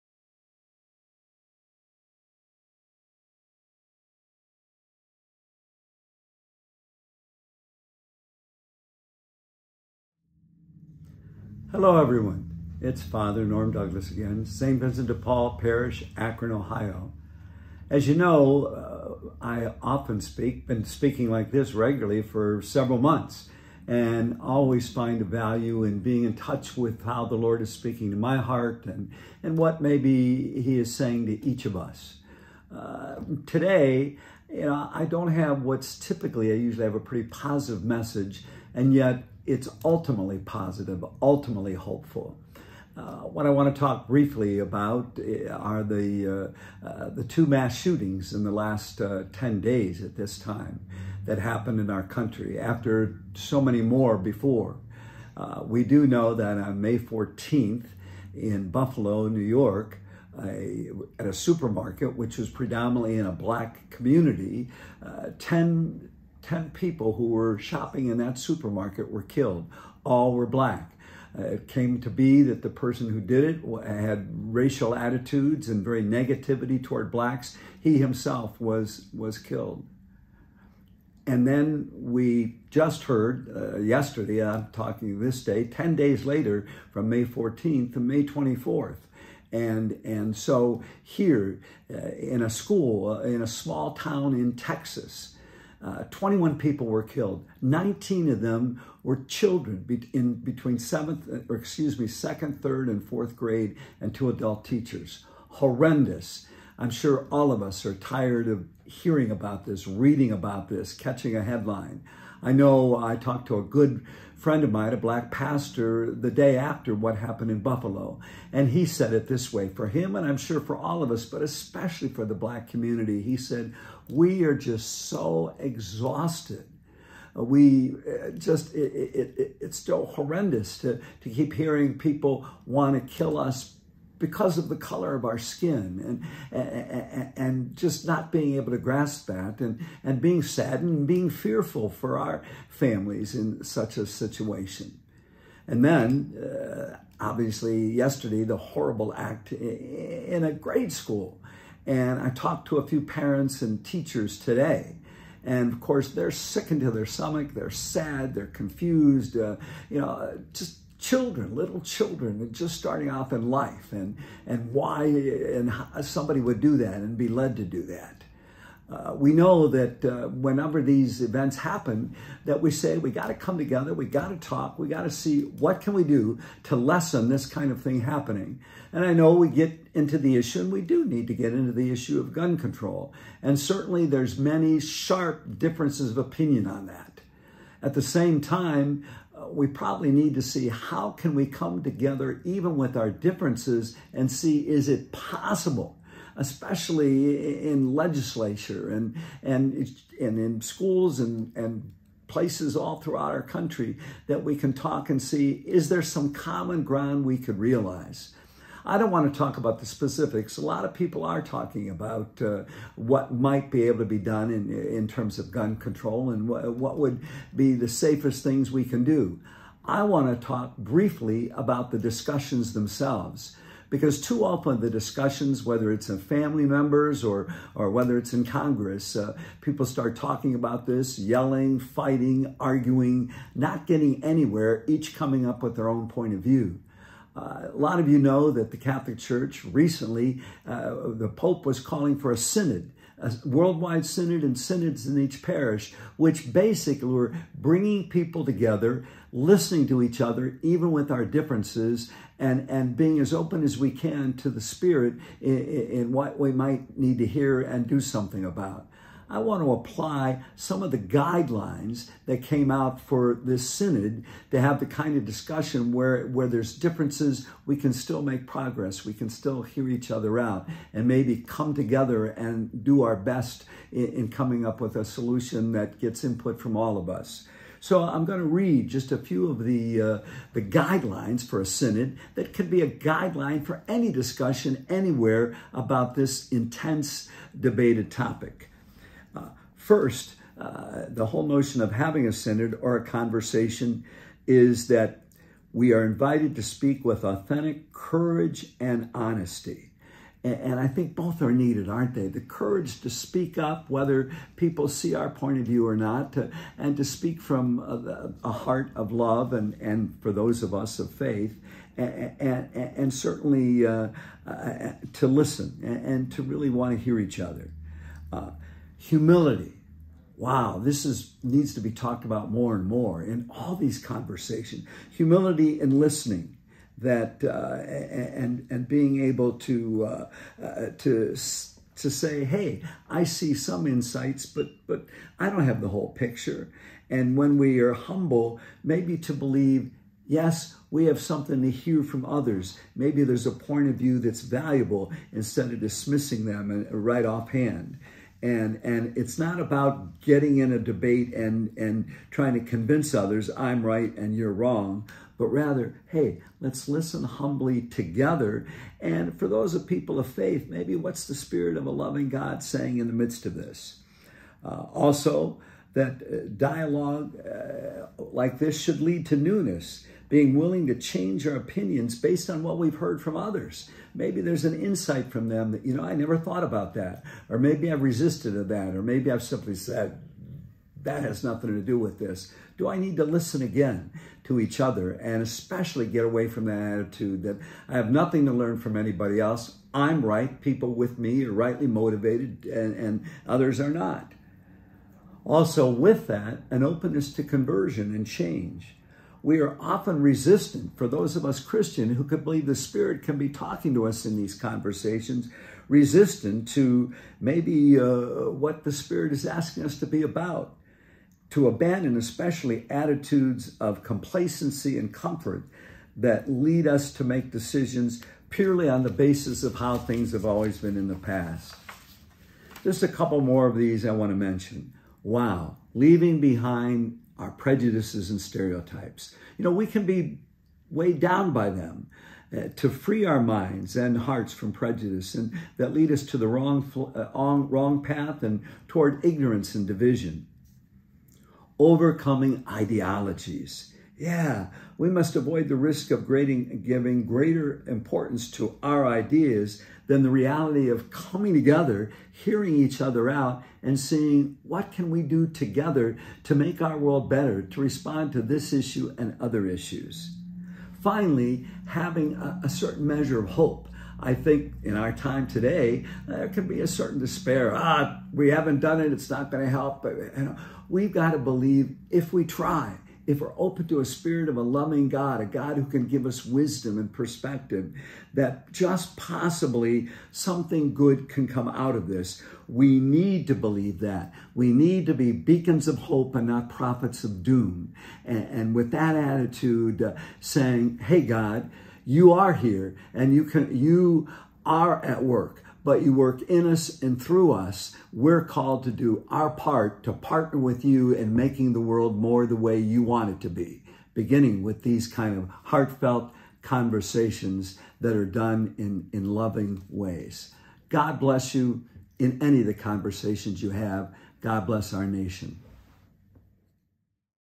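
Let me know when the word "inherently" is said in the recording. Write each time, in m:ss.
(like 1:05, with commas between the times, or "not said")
not said.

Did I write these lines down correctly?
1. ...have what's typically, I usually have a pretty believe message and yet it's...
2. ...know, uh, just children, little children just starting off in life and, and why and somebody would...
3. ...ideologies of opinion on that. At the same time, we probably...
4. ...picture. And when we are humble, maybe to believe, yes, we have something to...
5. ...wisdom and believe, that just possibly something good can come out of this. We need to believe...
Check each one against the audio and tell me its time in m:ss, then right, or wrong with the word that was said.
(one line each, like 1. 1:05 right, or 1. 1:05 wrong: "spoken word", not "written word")
1. 0:35 wrong: "positive", not "believe"
2. 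2:39 right
3. 3:05 wrong: "differences", not "ideologies"
4. 5:36 right
5. 7:56 wrong: "perspective", not "believe".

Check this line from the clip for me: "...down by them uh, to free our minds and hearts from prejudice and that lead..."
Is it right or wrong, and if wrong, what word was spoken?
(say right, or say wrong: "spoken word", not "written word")
right.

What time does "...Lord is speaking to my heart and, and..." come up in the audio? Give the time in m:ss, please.
0:27.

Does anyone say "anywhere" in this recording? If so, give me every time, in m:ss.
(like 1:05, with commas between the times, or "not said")
3:54, 4:44.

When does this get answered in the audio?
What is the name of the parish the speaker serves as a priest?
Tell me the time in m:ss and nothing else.
0:14.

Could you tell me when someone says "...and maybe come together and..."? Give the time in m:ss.
4:30.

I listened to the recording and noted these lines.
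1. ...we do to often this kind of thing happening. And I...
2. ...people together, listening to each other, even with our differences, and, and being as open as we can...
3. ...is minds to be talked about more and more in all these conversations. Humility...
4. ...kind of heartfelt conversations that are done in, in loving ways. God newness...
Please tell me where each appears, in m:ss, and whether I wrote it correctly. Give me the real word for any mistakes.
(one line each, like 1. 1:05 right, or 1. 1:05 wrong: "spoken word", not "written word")
1. 2:55 wrong: "lessen", not "often"
2. 4:08 right
3. 5:21 wrong: "needs", not "minds"
4. 8:25 wrong: "bless", not "newness".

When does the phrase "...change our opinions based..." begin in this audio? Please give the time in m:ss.
6:10.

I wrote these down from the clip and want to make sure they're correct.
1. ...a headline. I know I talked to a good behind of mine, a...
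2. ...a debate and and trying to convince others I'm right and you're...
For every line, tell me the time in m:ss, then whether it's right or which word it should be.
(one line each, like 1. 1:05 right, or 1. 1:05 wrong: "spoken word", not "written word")
1. 1:51 wrong: "friend", not "behind"
2. 5:50 right.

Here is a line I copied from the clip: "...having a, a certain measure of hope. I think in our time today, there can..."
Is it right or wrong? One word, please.
right.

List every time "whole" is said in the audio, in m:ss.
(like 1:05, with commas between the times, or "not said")
4:51, 5:35.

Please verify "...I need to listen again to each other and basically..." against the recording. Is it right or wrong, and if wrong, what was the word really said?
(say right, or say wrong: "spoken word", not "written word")
wrong: "especially", not "basically".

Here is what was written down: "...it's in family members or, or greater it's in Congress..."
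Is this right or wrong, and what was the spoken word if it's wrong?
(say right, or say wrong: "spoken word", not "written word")
wrong: "whether", not "greater".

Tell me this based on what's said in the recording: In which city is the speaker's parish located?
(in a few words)
Akron.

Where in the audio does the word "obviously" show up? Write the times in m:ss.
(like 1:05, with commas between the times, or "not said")
2:27.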